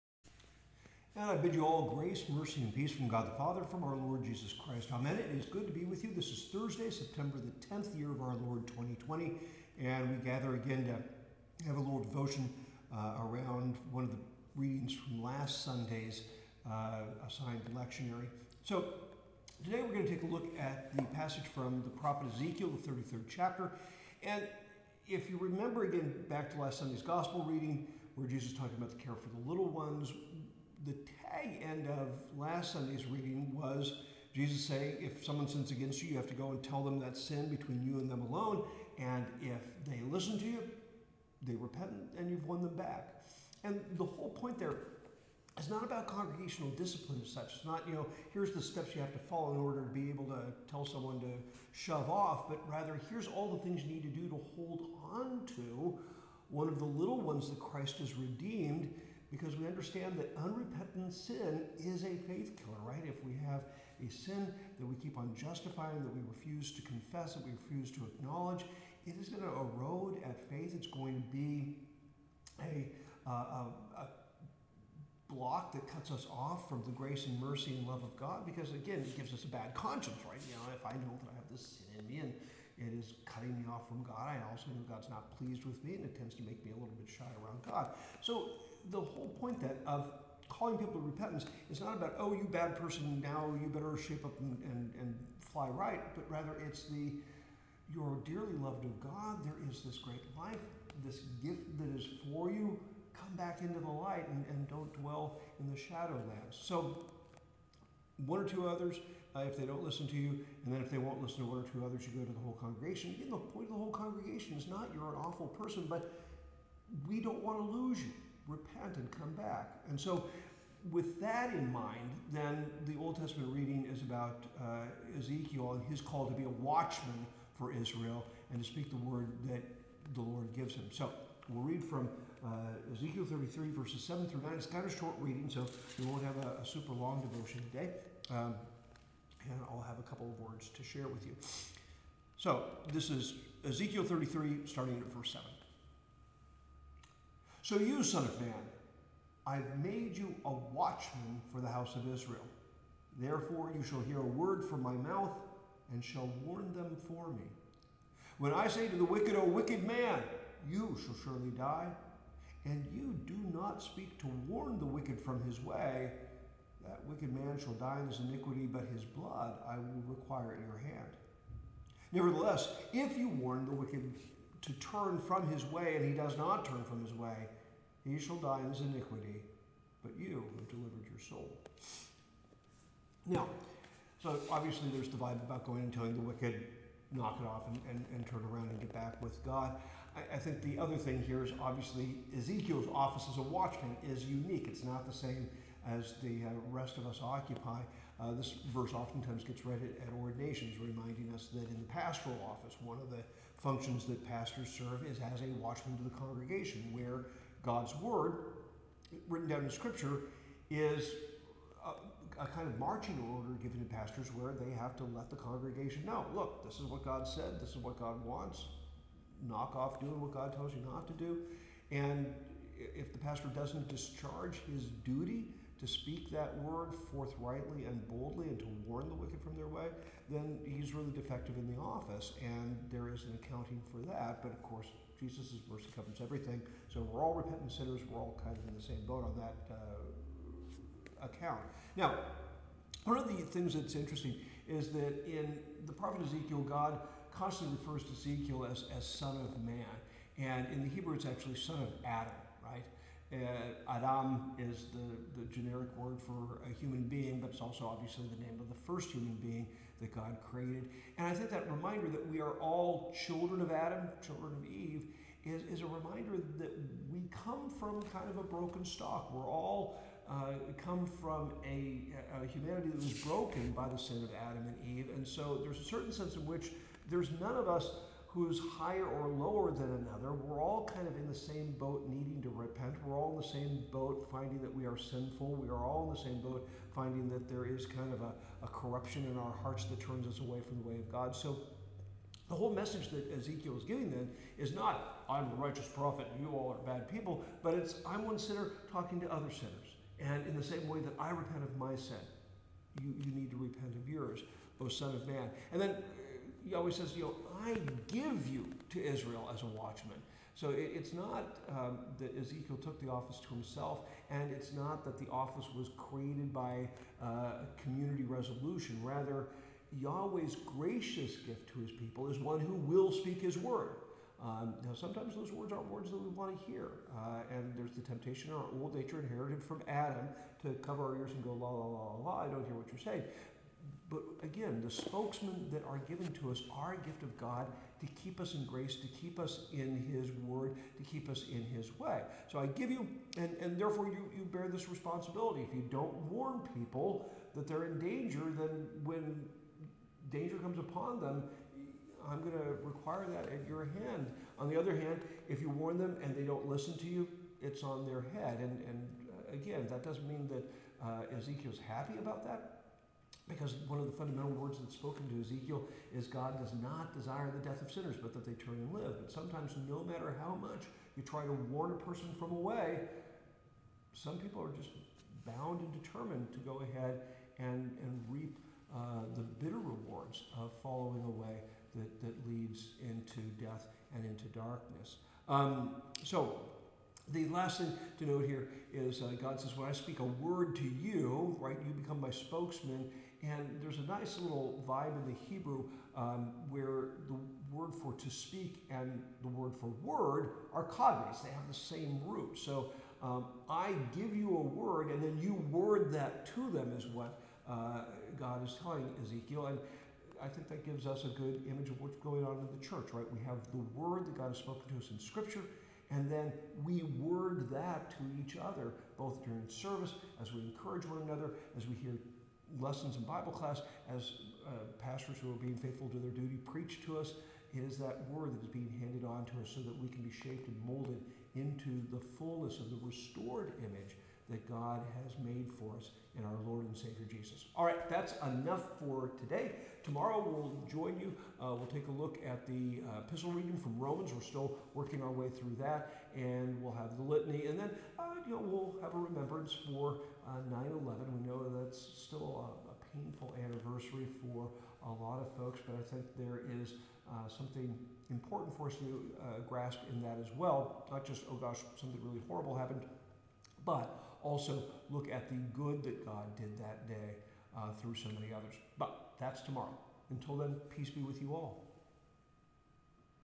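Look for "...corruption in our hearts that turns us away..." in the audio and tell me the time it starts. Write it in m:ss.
4:48.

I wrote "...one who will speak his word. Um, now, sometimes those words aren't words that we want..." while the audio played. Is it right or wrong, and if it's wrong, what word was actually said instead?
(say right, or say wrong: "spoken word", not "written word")
right.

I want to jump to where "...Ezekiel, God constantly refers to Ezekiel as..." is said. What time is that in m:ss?
4:06.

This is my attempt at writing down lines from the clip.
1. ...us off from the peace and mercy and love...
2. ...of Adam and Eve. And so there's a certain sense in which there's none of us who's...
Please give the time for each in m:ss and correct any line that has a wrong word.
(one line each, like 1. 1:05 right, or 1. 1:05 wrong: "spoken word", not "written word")
1. 1:16 wrong: "grace", not "peace"
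2. 4:34 right.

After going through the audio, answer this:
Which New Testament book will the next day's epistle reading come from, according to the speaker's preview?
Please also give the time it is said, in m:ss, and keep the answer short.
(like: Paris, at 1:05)
Romans, at 7:23.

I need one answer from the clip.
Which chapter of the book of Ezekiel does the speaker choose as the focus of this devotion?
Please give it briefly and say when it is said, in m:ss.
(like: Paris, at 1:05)
33, at 0:22.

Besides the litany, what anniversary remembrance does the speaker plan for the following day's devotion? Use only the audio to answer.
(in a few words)
9/11.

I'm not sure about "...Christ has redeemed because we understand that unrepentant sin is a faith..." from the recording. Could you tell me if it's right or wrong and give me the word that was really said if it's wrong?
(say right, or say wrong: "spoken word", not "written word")
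right.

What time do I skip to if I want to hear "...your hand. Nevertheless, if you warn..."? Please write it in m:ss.
2:50.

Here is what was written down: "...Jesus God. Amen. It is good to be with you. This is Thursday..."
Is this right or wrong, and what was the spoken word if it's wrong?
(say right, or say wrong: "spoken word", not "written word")
wrong: "Christ", not "God".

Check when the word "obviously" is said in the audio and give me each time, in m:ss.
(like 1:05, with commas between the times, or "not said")
3:04, 3:11, 4:17.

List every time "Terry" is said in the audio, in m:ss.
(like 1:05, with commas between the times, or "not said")
not said.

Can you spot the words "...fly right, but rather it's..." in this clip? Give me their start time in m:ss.
1:35.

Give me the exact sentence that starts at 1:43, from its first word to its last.
Come back into the light and, and don't dwell in the shadowlands.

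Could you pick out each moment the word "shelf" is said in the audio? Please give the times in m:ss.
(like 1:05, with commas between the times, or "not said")
not said.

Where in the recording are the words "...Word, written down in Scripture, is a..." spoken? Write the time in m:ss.
3:27.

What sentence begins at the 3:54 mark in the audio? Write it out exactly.
But of course, Jesus' mercy covers everything.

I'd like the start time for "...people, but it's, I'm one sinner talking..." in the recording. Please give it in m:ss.
4:57.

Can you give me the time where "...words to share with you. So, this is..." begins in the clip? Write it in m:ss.
2:20.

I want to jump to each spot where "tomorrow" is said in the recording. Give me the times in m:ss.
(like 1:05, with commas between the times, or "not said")
7:20, 7:49.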